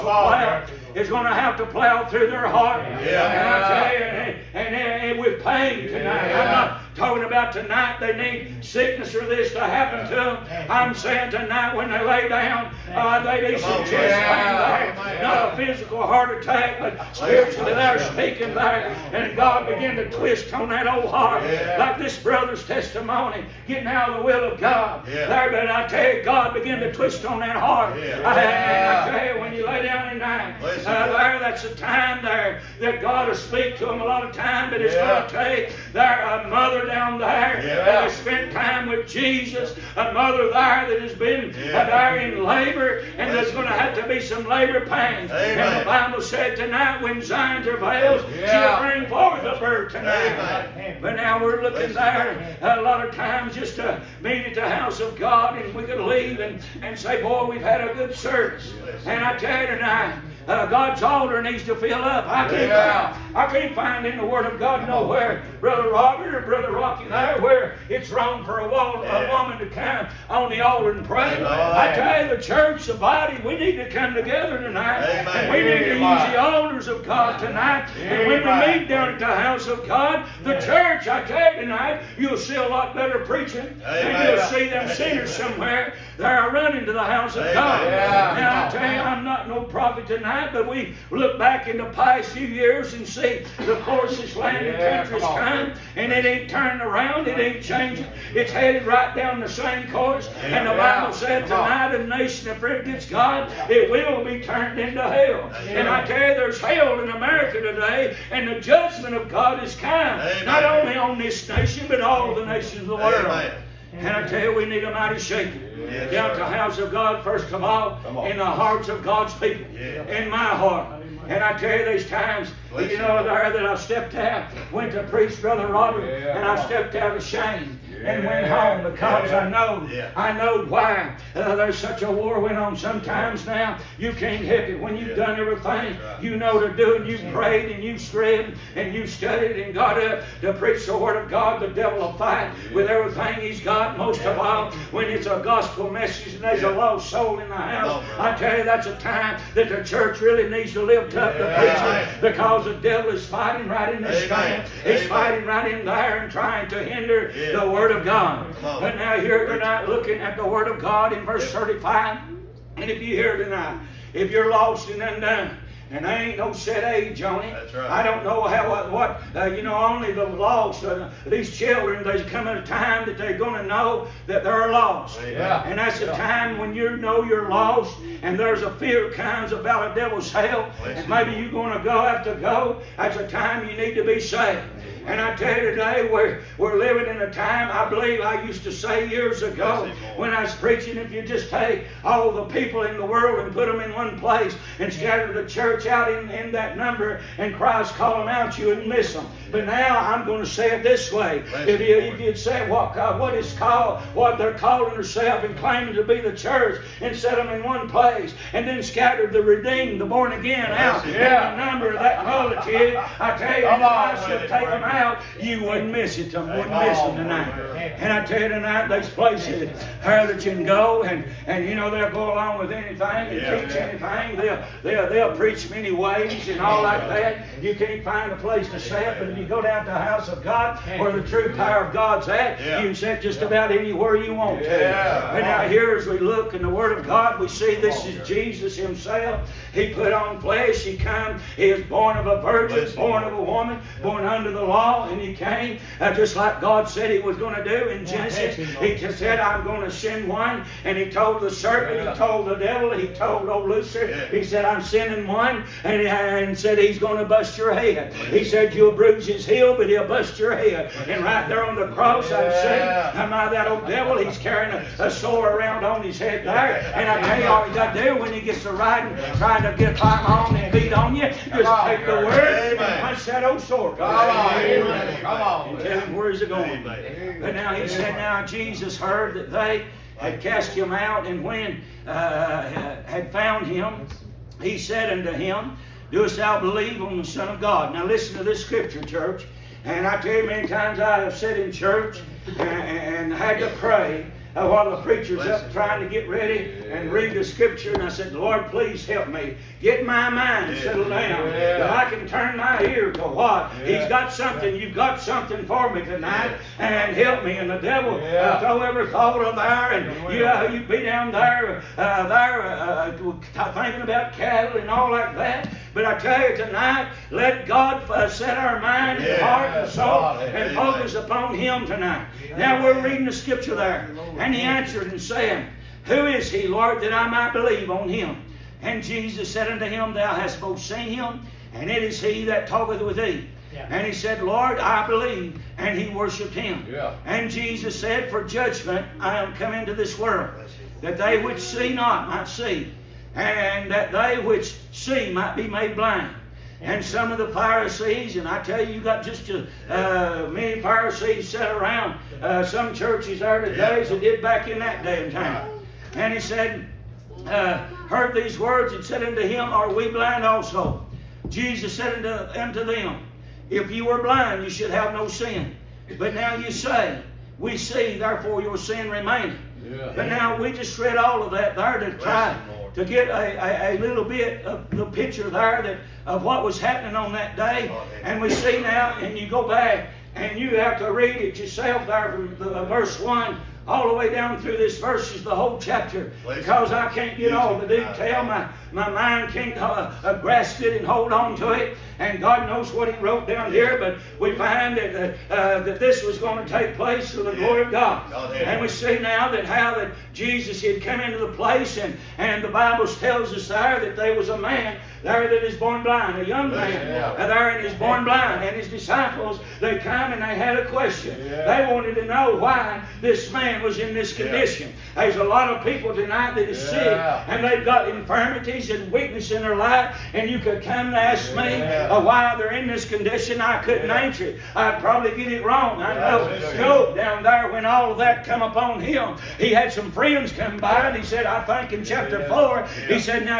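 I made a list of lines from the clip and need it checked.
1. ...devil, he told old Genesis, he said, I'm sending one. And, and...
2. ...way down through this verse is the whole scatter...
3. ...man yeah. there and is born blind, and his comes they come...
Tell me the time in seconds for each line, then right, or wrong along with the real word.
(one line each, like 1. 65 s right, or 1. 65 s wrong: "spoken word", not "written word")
1. 252 s wrong: "Lucifer", not "Genesis"
2. 384 s wrong: "chapter", not "scatter"
3. 406 s wrong: "disciples", not "comes".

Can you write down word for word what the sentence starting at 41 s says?
there in labor, and there's going to have to be some labor pains.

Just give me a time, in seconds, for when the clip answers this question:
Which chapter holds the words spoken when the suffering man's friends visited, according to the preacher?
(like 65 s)
432 s.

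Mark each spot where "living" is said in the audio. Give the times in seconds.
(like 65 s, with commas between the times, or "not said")
186 s.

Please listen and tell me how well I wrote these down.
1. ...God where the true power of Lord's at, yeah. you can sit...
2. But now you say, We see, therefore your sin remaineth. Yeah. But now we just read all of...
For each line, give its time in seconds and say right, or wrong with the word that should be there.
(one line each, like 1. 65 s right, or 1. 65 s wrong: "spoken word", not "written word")
1. 230 s wrong: "God", not "Lord"
2. 366 s right.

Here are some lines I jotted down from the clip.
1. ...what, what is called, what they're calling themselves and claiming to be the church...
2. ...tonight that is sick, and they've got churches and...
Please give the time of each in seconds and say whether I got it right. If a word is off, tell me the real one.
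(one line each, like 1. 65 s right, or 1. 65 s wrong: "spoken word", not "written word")
1. 202 s right
2. 416 s wrong: "infirmities", not "churches".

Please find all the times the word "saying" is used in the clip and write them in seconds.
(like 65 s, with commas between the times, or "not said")
10 s, 262 s.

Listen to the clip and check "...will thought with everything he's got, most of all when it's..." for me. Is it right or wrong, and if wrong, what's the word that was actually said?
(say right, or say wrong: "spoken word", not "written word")
wrong: "fight", not "thought".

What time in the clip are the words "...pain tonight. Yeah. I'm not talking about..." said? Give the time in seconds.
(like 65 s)
5 s.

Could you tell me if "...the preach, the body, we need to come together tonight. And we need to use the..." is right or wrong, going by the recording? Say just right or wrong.
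wrong.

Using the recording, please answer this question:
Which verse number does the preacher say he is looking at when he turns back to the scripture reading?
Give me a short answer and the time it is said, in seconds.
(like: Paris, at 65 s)
35, at 161 s.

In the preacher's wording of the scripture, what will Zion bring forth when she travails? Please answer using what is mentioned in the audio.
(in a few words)
A bird.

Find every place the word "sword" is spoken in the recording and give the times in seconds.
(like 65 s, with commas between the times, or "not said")
265 s, 273 s.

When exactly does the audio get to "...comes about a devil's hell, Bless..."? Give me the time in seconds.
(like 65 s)
179 s.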